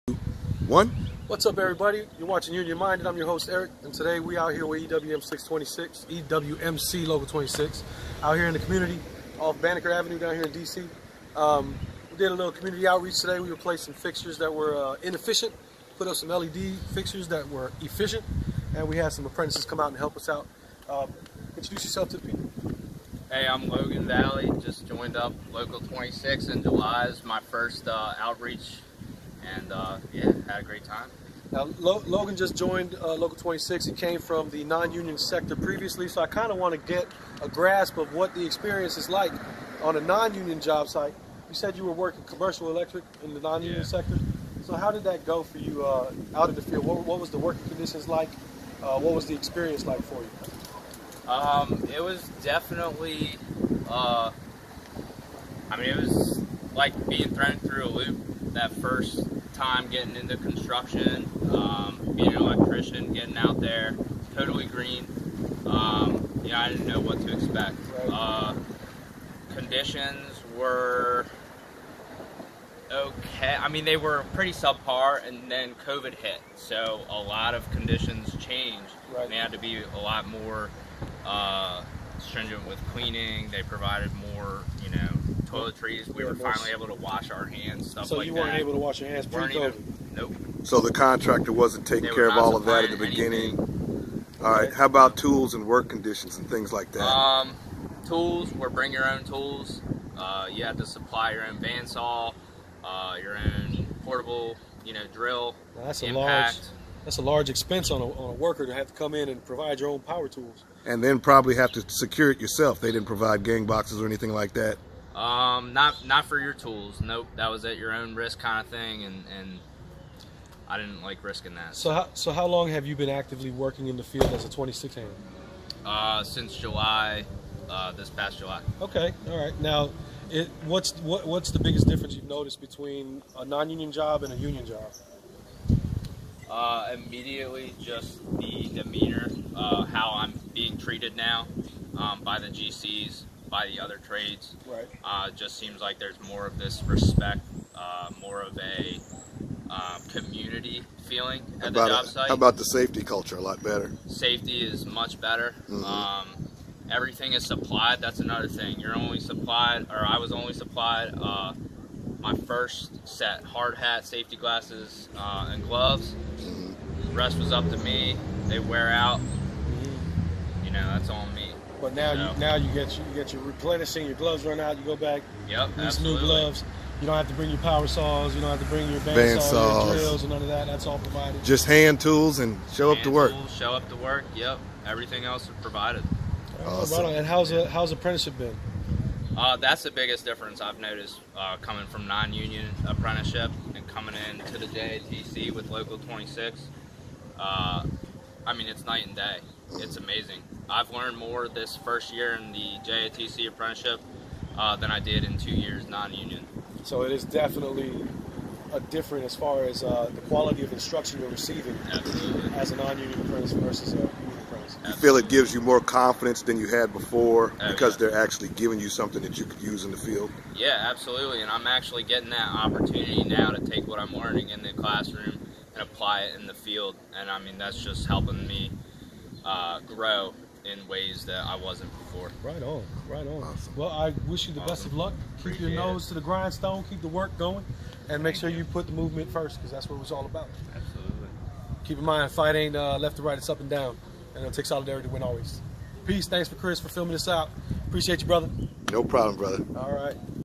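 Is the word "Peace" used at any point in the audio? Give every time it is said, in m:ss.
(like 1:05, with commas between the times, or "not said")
4:06.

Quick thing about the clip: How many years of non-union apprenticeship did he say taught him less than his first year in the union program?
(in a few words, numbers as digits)
2.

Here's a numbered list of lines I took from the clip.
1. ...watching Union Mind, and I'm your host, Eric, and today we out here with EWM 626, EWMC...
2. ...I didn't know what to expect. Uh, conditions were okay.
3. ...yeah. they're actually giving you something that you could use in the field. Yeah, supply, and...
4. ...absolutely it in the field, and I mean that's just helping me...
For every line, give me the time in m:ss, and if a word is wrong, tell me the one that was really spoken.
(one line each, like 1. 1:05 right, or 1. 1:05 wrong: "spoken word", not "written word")
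1. 0:02 right
2. 1:06 right
3. 3:37 wrong: "absolutely", not "supply"
4. 3:45 wrong: "apply", not "absolutely".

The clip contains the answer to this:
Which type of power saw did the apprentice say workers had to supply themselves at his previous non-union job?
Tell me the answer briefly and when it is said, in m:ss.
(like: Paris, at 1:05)
Bandsaw, at 1:41.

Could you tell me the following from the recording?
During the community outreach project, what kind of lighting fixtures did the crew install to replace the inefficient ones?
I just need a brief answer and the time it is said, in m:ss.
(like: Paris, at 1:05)
LED fixtures, at 0:16.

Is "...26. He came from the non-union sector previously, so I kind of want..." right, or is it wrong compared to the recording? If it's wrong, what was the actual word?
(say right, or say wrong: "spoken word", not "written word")
right.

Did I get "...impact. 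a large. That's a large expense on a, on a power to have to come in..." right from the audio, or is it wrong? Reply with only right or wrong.
wrong.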